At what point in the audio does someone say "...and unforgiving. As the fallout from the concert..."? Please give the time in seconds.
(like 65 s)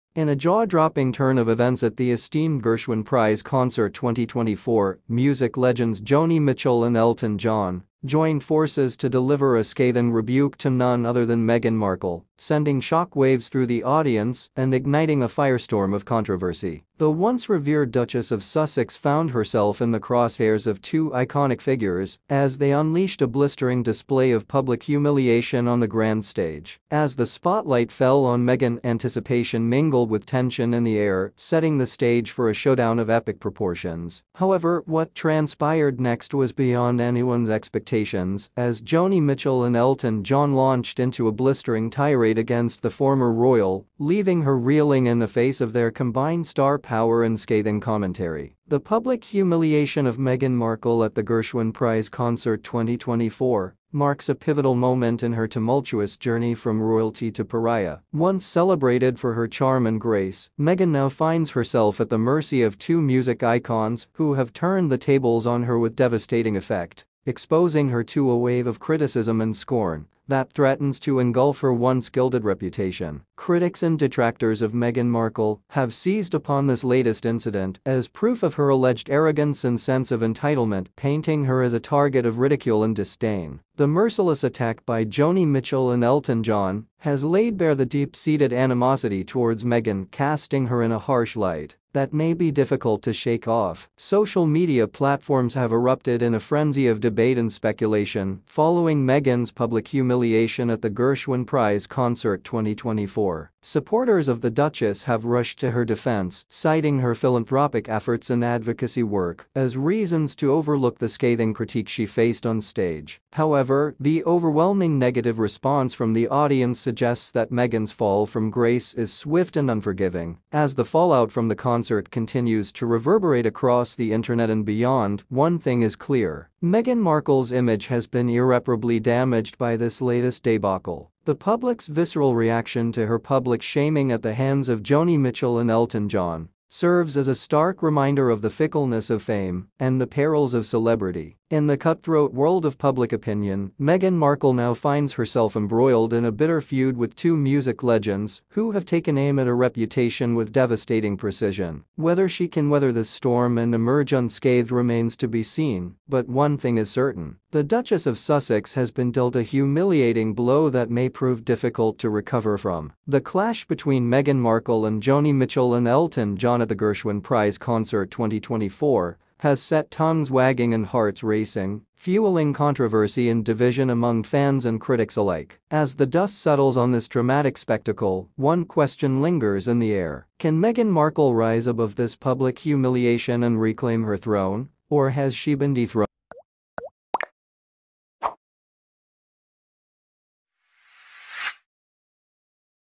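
119 s.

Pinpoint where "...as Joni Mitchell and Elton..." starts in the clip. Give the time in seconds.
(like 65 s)
38 s.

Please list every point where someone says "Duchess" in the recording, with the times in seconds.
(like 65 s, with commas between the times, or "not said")
17 s, 104 s, 157 s.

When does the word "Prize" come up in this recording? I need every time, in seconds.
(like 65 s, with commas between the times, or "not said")
3 s, 51 s, 101 s, 167 s.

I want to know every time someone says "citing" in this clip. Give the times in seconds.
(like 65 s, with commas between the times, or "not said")
106 s.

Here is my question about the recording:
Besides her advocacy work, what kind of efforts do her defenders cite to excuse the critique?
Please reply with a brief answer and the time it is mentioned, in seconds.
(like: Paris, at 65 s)
philanthropic, at 107 s.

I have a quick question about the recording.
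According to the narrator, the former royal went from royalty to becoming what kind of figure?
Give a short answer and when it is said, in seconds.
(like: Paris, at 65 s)
pariah, at 57 s.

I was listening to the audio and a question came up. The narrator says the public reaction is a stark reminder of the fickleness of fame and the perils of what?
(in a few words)
celebrity.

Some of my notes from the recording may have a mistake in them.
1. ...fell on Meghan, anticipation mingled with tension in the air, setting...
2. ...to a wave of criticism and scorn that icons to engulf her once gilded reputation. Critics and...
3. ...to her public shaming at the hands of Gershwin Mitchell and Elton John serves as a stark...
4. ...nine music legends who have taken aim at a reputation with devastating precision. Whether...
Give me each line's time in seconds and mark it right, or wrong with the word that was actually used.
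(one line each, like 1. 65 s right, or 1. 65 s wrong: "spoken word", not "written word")
1. 27 s right
2. 68 s wrong: "threatens", not "icons"
3. 132 s wrong: "Joni", not "Gershwin"
4. 147 s wrong: "two", not "nine".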